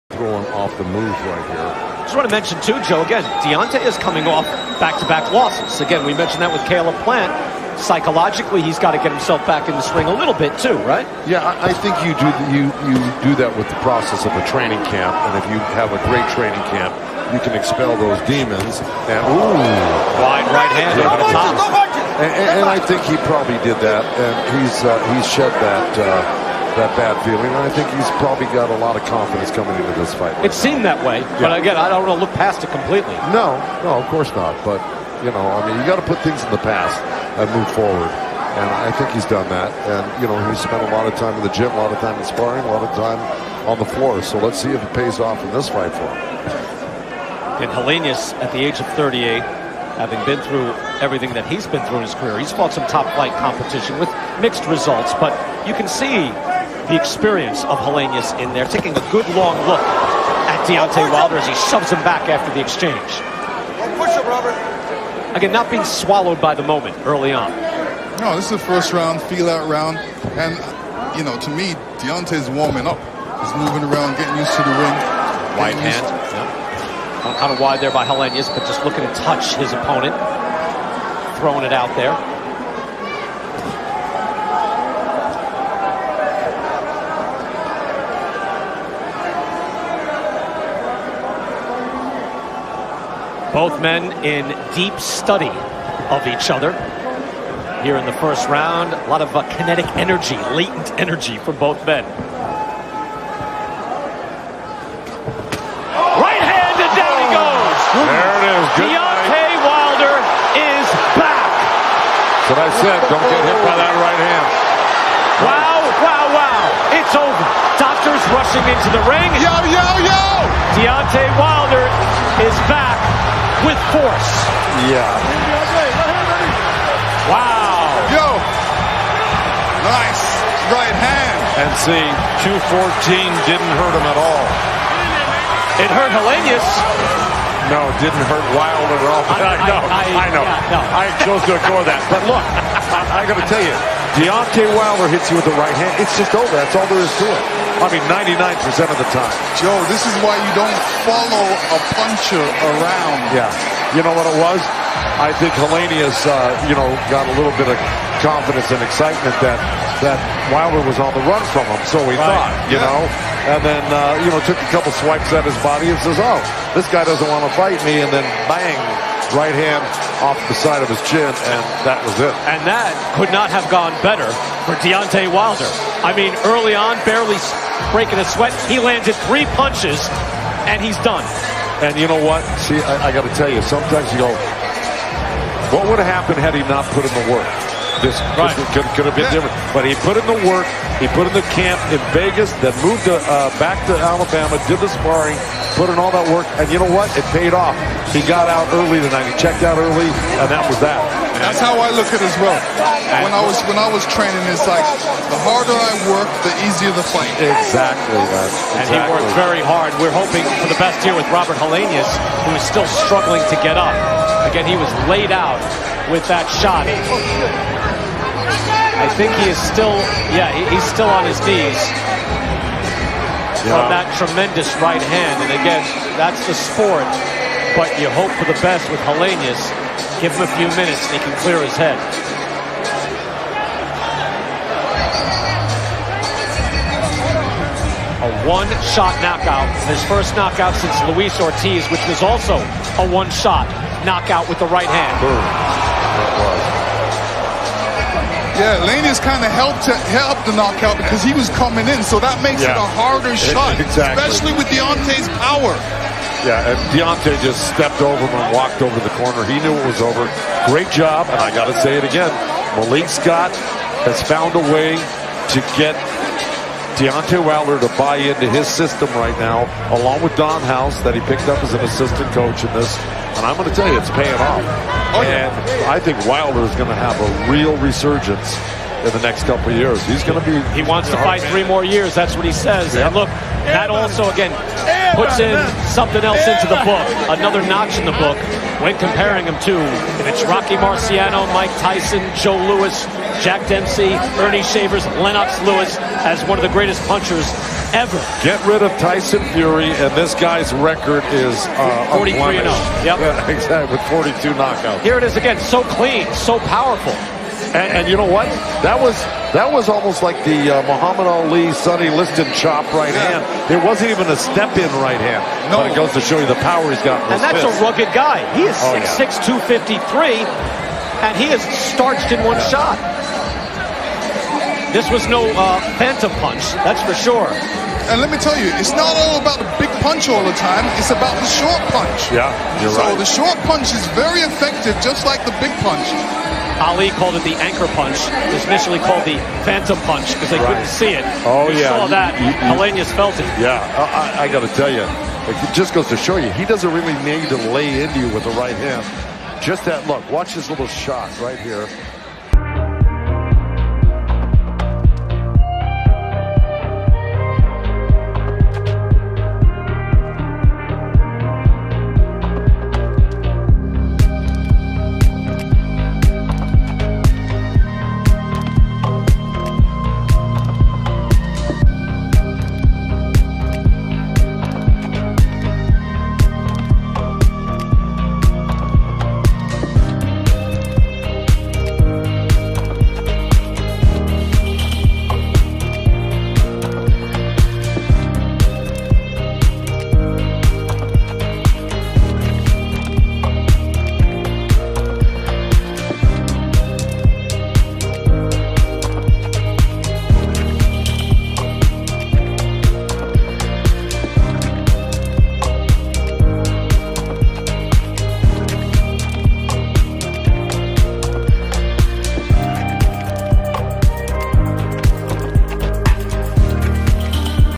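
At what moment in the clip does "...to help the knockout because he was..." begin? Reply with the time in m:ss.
4:09.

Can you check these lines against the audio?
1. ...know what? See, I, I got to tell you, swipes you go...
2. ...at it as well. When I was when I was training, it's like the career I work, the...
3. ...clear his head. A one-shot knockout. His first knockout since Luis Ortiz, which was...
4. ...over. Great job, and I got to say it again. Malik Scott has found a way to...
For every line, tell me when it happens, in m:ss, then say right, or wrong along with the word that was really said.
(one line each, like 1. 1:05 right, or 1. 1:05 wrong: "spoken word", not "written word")
1. 3:02 wrong: "sometimes", not "swipes"
2. 3:22 wrong: "harder", not "career"
3. 3:51 right
4. 4:20 right.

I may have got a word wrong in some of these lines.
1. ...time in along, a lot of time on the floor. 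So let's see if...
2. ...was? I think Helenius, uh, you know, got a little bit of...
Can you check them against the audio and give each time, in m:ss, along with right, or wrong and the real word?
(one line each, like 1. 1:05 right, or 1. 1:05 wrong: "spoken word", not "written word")
1. 0:41 wrong: "sparring", not "along"
2. 2:34 right.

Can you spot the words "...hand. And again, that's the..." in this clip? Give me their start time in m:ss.
3:45.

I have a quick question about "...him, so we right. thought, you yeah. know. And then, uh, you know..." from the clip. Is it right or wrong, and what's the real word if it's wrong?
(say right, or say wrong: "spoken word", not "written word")
right.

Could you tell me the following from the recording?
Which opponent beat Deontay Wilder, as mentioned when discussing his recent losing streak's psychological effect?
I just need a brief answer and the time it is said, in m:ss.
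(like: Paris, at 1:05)
Caleb Plant, at 0:06.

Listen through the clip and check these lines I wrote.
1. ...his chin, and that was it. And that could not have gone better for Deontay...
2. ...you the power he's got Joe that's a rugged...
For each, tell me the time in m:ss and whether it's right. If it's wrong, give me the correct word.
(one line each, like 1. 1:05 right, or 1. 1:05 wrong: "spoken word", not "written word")
1. 2:50 right
2. 5:16 wrong: "And", not "Joe".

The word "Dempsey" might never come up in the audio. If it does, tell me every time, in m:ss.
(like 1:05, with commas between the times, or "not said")
4:53.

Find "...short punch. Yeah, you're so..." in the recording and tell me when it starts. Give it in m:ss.
5:31.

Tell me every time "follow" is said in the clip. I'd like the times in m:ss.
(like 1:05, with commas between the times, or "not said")
2:31.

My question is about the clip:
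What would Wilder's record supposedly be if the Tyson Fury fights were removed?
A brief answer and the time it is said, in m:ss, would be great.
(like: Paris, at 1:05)
43 and 0, at 5:02.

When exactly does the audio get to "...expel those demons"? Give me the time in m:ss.
0:17.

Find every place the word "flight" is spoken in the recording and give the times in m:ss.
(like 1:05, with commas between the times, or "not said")
0:53.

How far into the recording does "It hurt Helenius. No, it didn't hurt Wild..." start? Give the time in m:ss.
2:15.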